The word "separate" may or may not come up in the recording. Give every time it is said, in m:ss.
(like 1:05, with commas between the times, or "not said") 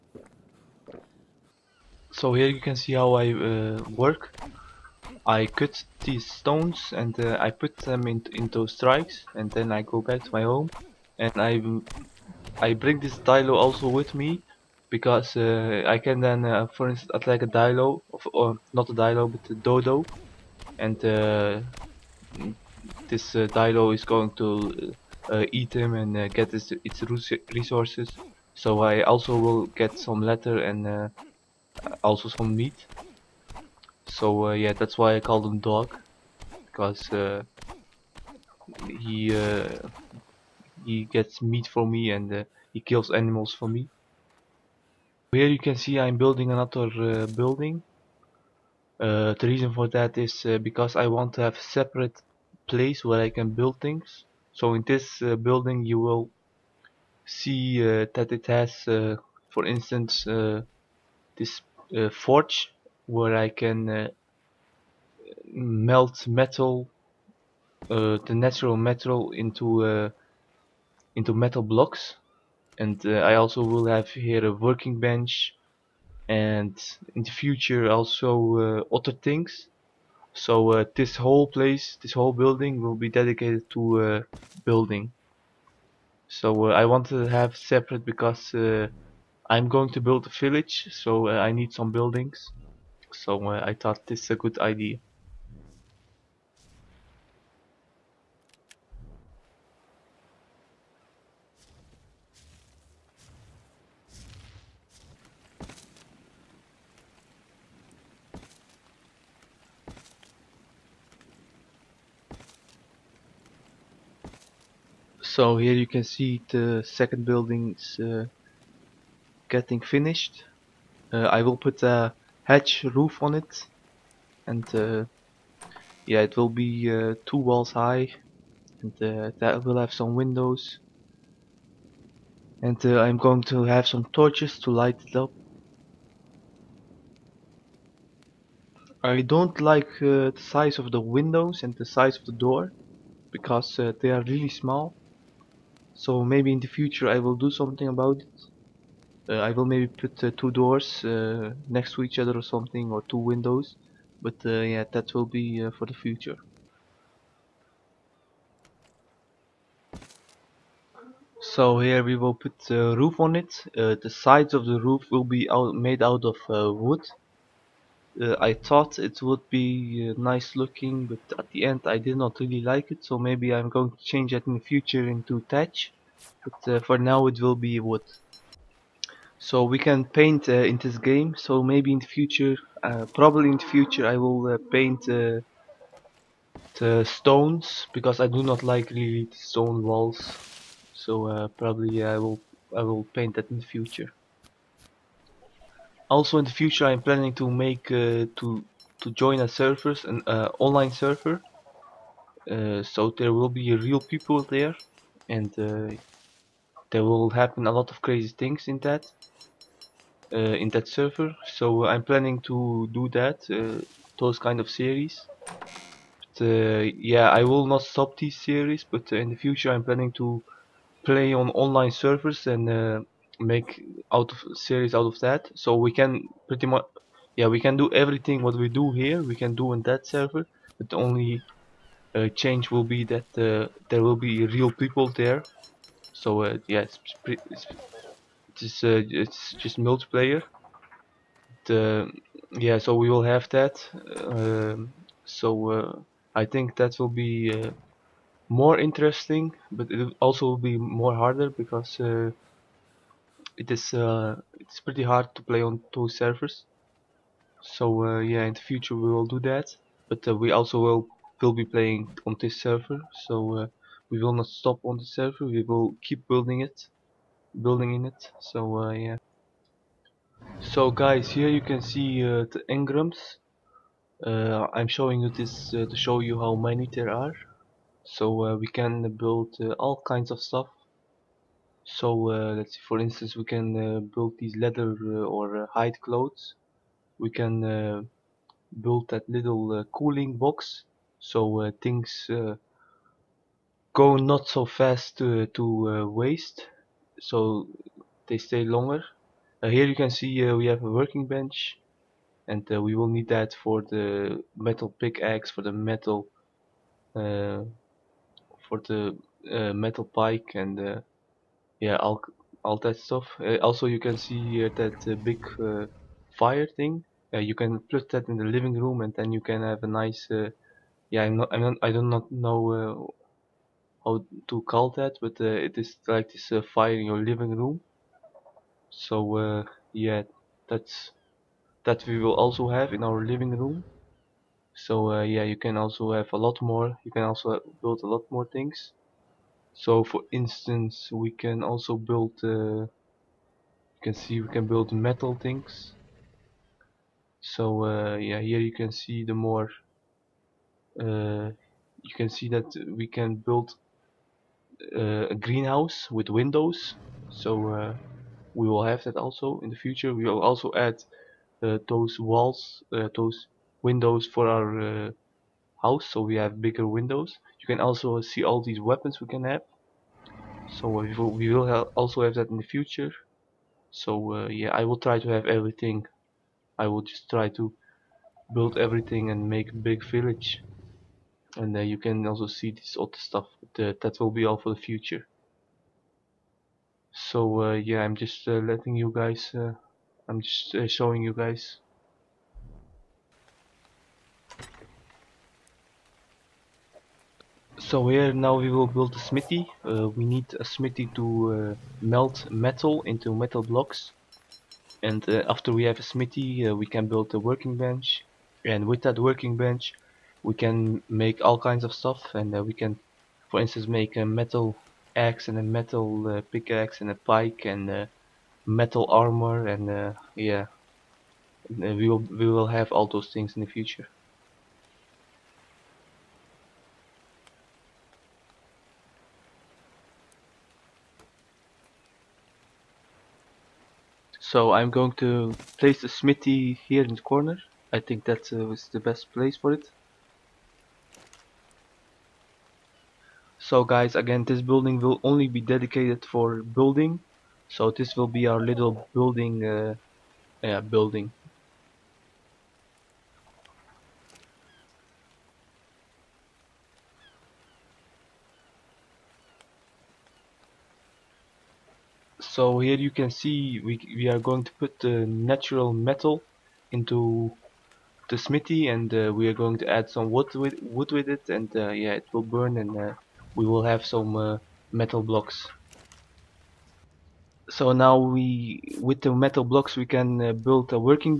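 0:51, 1:27.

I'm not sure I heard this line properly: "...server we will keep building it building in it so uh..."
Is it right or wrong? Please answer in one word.
right.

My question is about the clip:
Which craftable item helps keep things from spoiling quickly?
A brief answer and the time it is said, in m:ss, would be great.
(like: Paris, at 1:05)
cooling box, at 4:49.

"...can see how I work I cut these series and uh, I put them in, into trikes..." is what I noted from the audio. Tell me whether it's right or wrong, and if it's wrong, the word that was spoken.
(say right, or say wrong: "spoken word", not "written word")
wrong: "stones", not "series".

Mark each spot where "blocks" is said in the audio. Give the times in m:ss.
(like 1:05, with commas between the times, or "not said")
1:11, 6:43, 7:55, 7:59.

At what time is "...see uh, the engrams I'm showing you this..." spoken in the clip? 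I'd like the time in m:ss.
4:31.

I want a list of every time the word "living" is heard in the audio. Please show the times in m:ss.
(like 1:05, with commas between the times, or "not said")
5:18, 5:27, 5:33.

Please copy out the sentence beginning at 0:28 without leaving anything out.
So I also will get some leather and uh, also some meat.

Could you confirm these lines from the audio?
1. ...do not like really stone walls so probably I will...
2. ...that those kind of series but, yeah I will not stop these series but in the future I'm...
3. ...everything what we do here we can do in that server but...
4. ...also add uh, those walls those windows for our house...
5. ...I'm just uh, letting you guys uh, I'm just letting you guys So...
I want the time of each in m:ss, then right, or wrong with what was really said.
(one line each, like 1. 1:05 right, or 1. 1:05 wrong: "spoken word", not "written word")
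1. 3:08 right
2. 3:33 right
3. 3:47 right
4. 6:00 right
5. 6:28 wrong: "showing", not "letting".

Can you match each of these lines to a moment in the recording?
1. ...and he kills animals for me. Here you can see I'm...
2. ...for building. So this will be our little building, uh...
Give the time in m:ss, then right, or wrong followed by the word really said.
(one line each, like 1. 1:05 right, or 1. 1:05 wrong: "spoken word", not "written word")
1. 0:42 right
2. 7:26 right.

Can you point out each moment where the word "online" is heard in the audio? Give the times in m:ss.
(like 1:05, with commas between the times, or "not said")
3:20, 3:41.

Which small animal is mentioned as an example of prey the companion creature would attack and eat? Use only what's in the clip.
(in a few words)
dodo.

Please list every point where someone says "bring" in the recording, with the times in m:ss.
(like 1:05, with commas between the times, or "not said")
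0:12.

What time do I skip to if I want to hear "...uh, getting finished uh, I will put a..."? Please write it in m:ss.
1:58.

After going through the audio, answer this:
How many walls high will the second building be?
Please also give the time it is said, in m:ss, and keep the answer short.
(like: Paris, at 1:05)
2, at 2:07.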